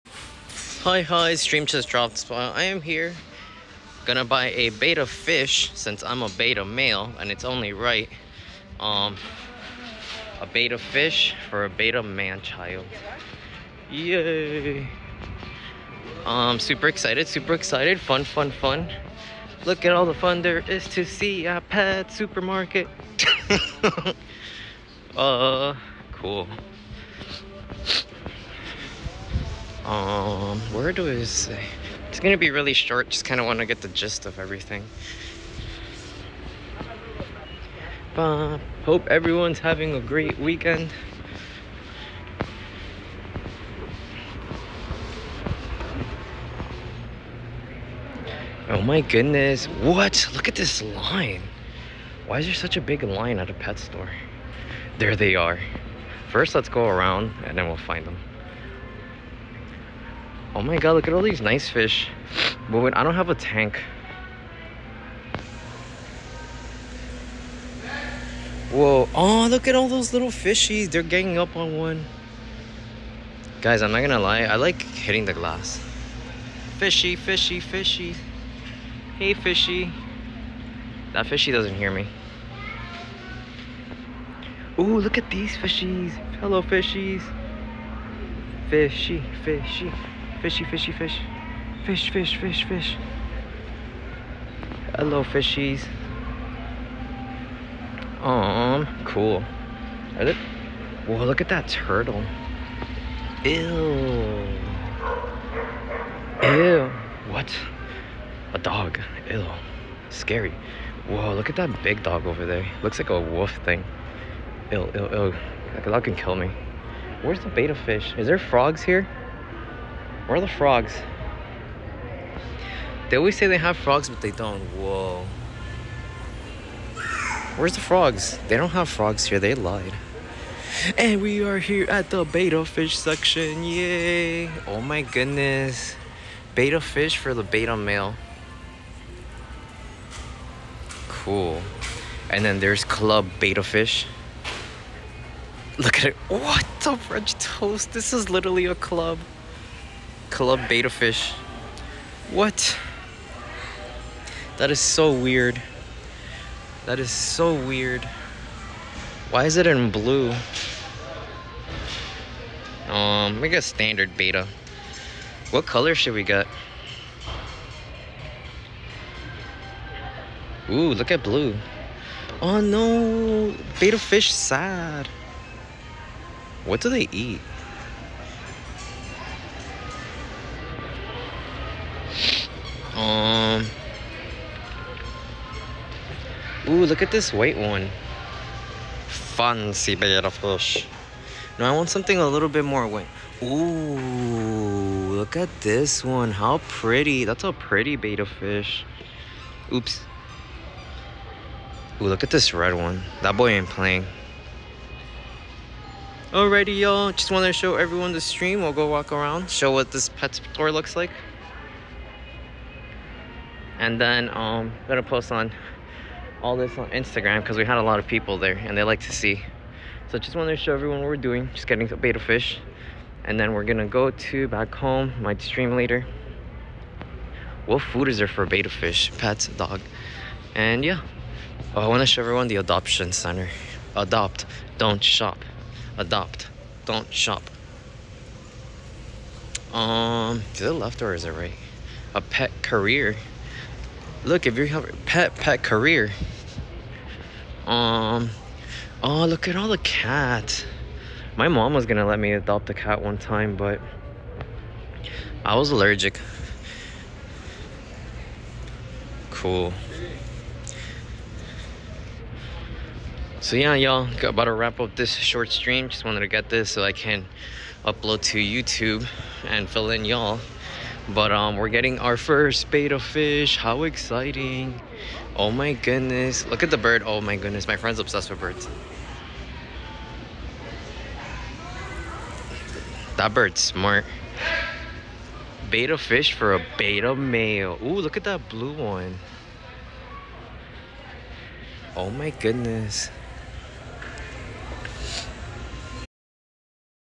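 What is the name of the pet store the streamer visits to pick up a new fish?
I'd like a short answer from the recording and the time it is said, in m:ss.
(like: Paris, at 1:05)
Pet Supermarket, at 0:21.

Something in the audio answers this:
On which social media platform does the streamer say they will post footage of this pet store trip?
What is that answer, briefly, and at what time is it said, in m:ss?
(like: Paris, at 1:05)
Instagram, at 3:36.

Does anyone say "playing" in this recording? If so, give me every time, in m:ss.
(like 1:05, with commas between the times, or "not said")
3:23.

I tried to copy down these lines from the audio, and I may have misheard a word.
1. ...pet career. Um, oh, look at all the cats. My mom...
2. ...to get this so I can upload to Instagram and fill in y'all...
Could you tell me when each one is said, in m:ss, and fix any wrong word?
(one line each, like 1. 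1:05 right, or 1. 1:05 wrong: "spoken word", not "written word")
1. 4:05 right
2. 4:26 wrong: "YouTube", not "Instagram".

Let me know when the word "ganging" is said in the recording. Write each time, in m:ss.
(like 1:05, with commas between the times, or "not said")
1:11.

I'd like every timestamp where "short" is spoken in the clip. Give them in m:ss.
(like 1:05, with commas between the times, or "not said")
0:32, 4:25.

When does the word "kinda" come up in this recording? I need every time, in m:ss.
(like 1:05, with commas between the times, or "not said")
0:33.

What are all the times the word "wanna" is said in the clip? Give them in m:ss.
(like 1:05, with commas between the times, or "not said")
0:33, 3:51.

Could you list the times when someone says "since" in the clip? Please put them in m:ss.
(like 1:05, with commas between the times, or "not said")
0:05.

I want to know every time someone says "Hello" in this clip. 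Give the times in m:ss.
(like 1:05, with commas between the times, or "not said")
1:26, 1:34.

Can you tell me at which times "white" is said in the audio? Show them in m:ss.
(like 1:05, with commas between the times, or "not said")
3:07, 3:12.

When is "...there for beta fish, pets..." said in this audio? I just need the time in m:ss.
3:48.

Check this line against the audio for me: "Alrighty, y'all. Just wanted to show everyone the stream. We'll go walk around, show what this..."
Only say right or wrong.
right.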